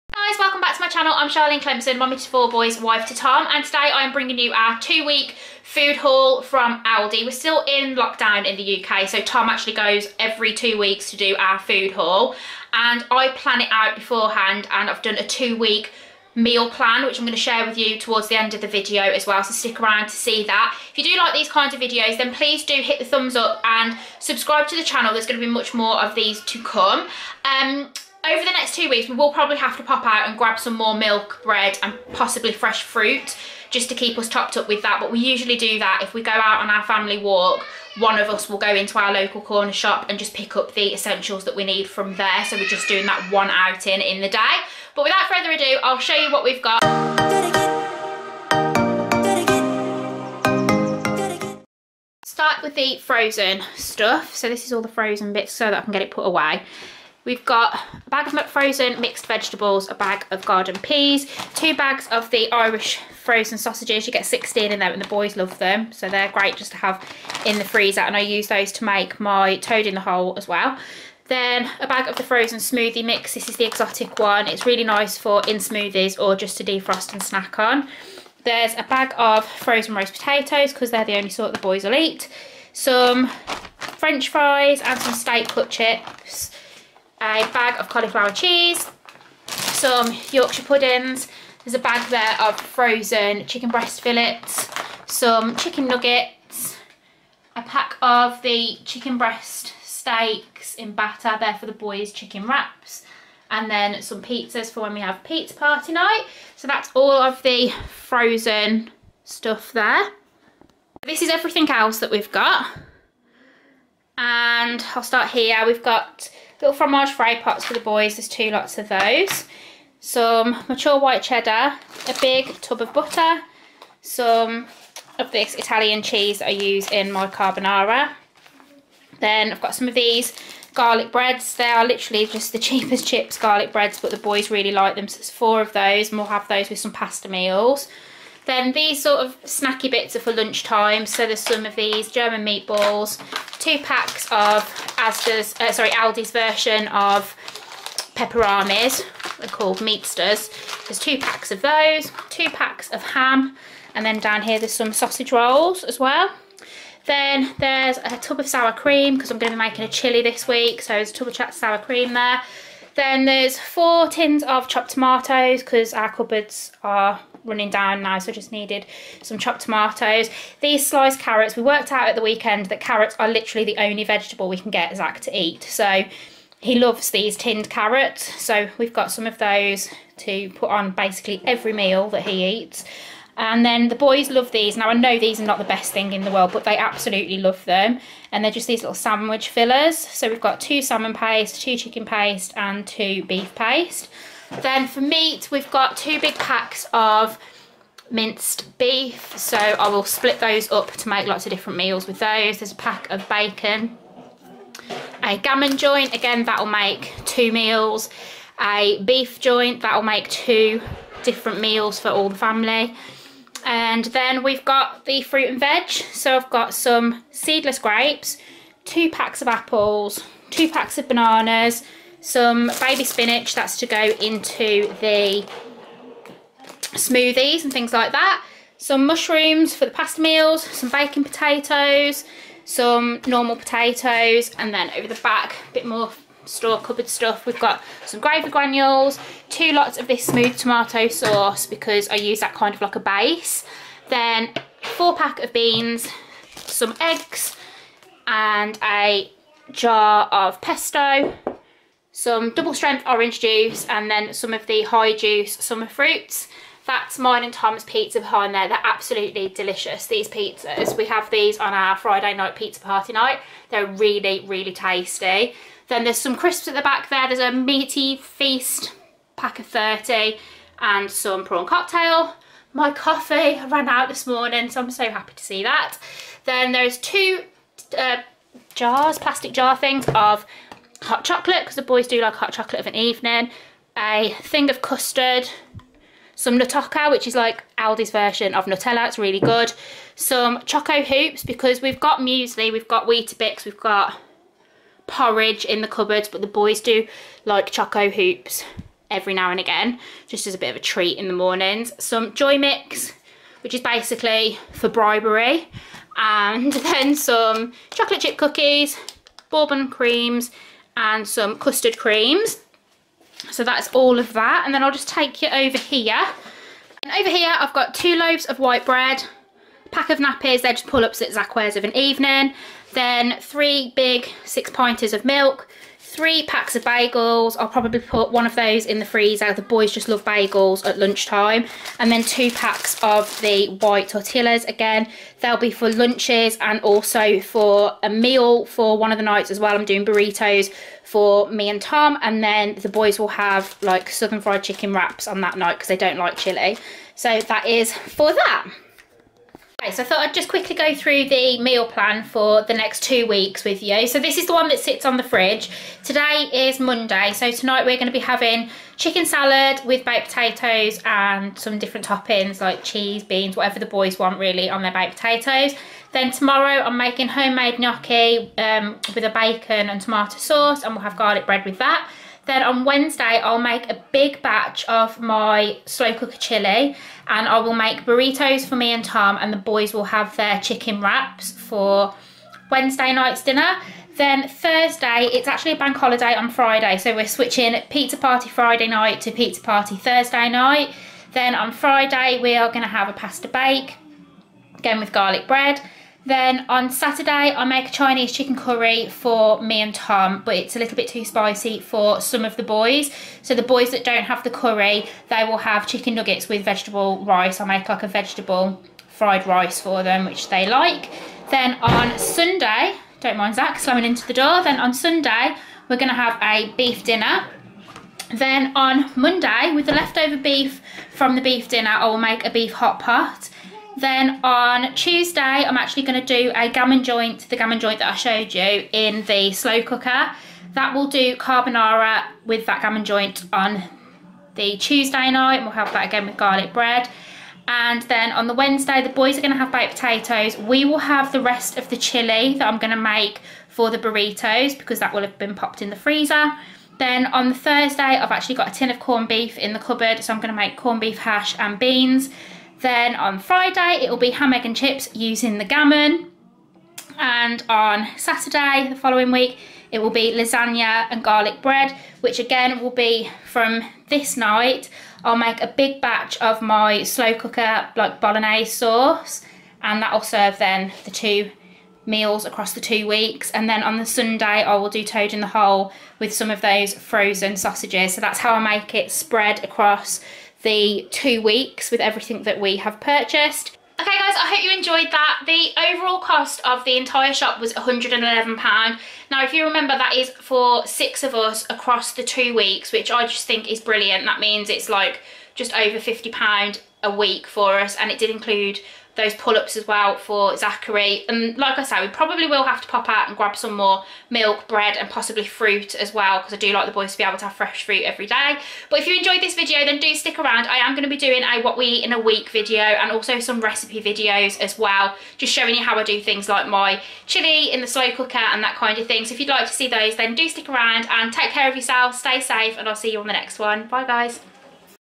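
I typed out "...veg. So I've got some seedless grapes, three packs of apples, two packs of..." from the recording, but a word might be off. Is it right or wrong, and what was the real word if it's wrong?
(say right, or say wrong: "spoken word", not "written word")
wrong: "two", not "three".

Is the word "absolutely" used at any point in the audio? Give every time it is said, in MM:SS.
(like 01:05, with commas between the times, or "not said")
03:06, 04:18.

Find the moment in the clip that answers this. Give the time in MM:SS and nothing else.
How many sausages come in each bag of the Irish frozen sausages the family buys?
01:04.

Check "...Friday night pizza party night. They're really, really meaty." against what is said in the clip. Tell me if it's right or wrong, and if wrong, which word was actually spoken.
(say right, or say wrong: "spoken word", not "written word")
wrong: "tasty", not "meaty".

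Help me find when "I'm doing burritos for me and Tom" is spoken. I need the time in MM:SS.
05:39.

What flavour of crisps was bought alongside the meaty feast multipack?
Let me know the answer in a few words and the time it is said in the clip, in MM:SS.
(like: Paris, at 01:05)
Prawn cocktail, at 04:31.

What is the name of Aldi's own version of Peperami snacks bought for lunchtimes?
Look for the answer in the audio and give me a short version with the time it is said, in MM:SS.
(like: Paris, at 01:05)
Meatsters, at 02:29.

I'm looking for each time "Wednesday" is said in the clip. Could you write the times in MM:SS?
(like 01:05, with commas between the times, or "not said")
06:12, 06:22, 07:18.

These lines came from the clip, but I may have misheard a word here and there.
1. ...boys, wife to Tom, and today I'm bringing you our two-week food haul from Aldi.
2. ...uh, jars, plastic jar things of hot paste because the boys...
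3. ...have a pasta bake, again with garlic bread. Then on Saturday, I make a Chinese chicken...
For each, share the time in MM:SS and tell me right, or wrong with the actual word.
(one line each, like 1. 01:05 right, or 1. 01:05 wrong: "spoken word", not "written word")
1. 00:02 right
2. 04:37 wrong: "chocolate", not "paste"
3. 06:32 right.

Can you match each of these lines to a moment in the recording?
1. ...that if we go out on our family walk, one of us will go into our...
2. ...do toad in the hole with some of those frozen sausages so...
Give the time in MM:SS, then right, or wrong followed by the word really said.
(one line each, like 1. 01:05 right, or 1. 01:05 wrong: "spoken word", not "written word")
1. 00:35 right
2. 07:54 right.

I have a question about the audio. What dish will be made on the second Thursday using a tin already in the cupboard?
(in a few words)
Corned beef hash.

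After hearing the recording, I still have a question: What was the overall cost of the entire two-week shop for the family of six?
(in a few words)
£111.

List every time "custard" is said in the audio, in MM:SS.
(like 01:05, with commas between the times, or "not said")
04:44, 05:11.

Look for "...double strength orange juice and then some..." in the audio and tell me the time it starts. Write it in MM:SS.
04:12.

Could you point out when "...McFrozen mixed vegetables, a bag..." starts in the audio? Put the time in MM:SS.
00:58.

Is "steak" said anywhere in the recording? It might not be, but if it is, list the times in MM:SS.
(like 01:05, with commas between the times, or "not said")
01:25, 01:39.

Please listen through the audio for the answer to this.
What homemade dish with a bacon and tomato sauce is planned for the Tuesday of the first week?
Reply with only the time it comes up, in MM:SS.
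06:07.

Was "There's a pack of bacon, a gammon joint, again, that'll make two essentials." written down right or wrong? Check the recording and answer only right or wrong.
wrong.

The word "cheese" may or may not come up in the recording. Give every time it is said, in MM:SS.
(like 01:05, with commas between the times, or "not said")
01:28, 02:06, 06:02.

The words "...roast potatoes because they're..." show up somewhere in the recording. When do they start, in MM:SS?
01:19.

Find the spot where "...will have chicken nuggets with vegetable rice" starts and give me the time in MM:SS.
06:45.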